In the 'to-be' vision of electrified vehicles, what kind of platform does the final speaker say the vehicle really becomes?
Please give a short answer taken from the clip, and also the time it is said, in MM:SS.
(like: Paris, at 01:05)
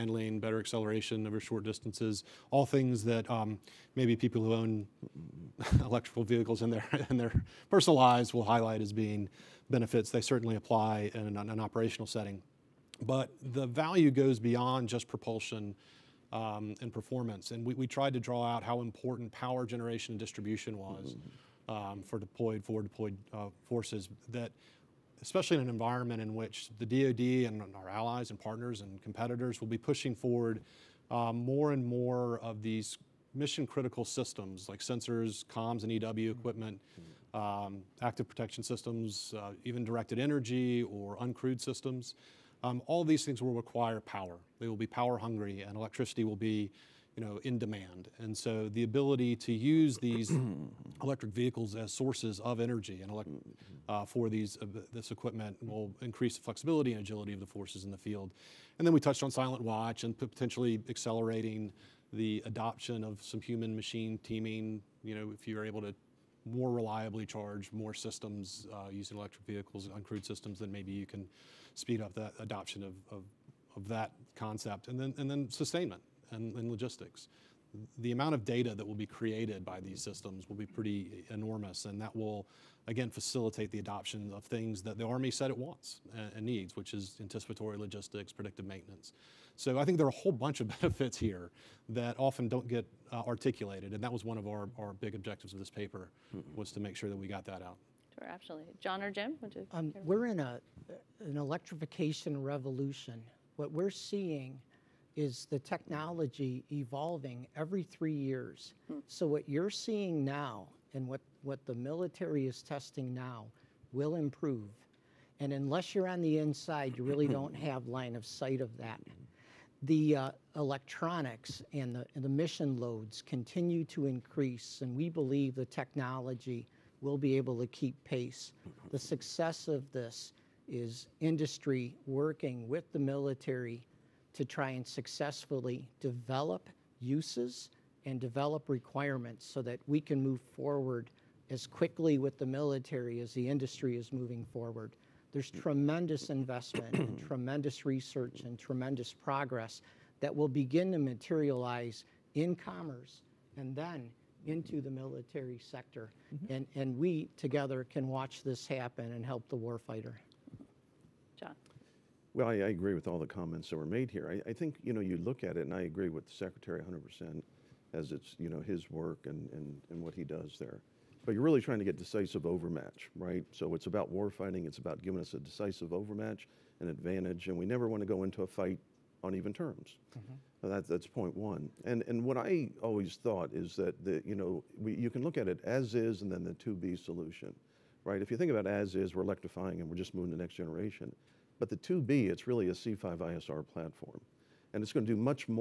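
C5 ISR platform, at 03:12.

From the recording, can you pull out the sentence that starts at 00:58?
And then we touched on silent watch and potentially accelerating the adoption of some human machine teaming.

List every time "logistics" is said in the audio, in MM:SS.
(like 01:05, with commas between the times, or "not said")
01:16, 01:27.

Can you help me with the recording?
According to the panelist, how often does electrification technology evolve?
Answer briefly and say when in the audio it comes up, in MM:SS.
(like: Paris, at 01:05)
Every three years, at 01:47.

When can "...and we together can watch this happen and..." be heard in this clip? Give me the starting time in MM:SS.
02:36.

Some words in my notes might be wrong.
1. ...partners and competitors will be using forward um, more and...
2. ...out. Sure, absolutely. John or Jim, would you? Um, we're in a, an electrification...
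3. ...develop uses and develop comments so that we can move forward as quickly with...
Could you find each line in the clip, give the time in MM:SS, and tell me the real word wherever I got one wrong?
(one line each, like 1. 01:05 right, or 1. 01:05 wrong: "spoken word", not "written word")
1. 00:28 wrong: "pushing", not "using"
2. 01:37 right
3. 02:15 wrong: "requirements", not "comments".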